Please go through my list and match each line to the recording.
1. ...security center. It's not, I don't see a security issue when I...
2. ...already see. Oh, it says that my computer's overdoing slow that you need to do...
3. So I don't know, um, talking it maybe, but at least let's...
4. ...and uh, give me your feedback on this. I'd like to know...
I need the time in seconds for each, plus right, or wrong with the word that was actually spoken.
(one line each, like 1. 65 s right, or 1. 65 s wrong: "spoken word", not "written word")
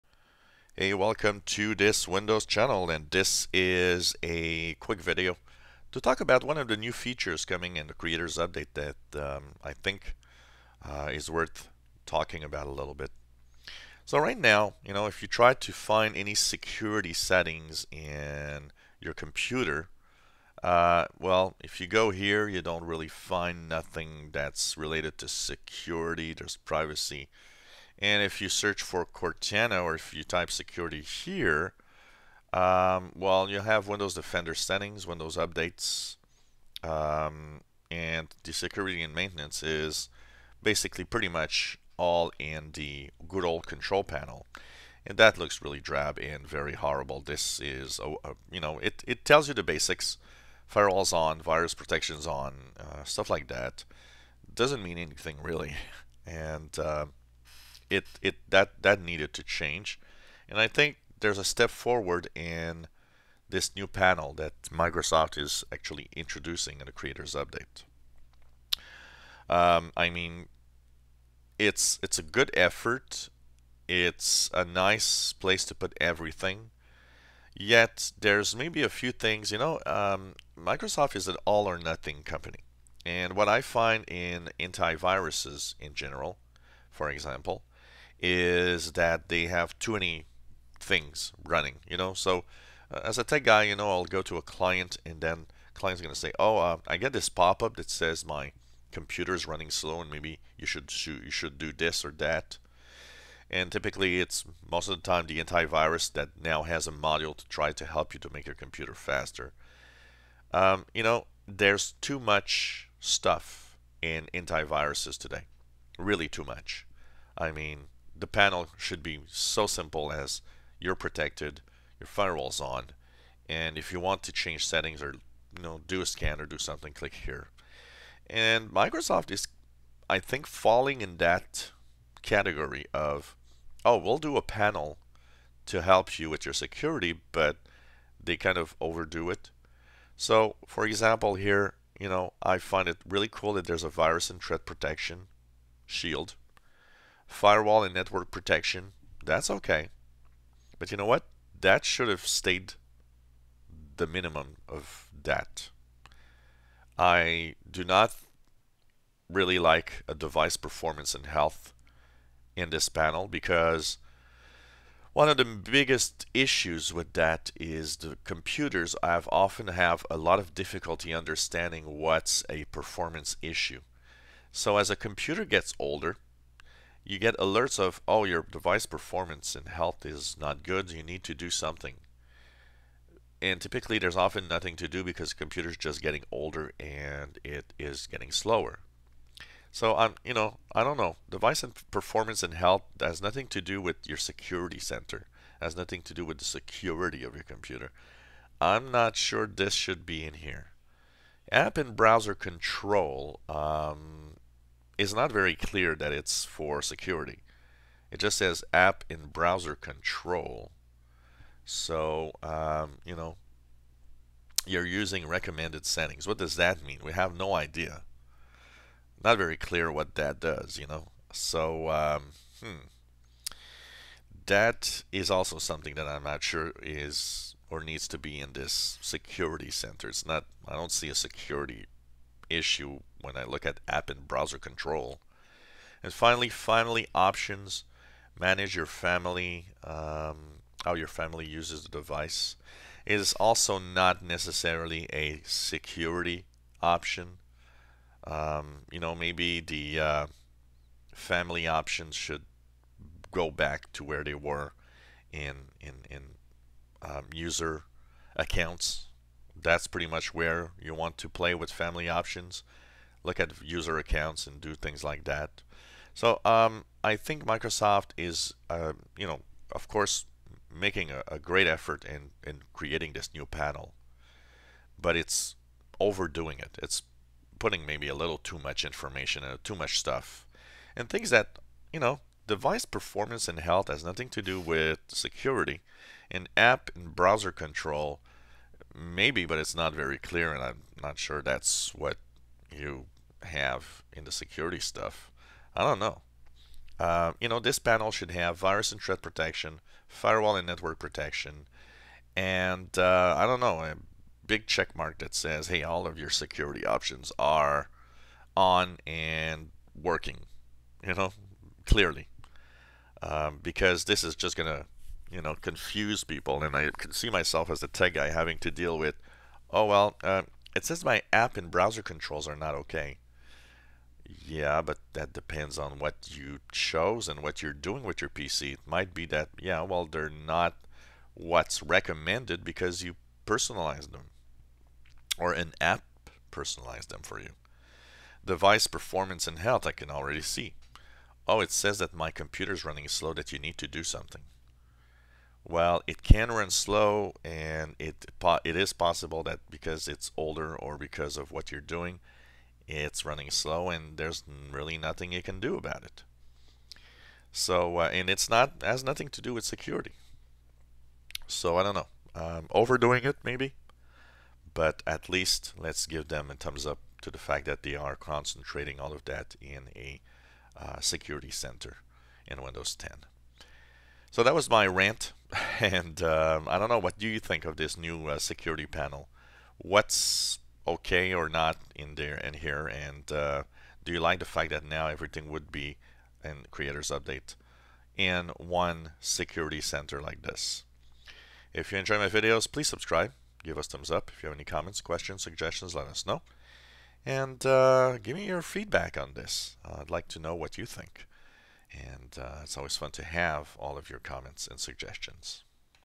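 1. 228 s right
2. 340 s wrong: "running", not "overdoing"
3. 361 s wrong: "overdoing", not "talking"
4. 397 s right.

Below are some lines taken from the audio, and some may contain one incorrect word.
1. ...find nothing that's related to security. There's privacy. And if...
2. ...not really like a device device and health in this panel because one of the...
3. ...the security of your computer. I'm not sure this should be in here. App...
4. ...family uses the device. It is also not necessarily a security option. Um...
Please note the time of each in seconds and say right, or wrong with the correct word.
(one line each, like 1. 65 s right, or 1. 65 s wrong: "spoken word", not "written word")
1. 23 s right
2. 157 s wrong: "performance", not "device"
3. 196 s right
4. 241 s right.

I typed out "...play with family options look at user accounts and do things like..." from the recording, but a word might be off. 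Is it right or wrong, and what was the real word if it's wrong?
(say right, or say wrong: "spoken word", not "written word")
right.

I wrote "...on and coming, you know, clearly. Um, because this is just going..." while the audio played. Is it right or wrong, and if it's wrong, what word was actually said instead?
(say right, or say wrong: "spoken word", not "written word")
wrong: "working", not "coming".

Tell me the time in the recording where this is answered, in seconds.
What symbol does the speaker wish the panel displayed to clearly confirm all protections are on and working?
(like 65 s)
303 s.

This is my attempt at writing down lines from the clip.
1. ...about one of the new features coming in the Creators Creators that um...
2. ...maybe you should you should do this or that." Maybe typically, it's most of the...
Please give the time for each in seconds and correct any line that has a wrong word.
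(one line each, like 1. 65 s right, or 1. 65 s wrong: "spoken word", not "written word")
1. 6 s wrong: "Update", not "Creators"
2. 100 s wrong: "And", not "Maybe".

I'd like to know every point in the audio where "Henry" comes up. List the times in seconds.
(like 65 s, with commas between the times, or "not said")
not said.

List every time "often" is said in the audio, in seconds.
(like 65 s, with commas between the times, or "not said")
169 s, 184 s.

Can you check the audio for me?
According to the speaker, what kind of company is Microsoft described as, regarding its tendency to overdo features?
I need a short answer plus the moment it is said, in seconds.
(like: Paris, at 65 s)
all or nothing, at 81 s.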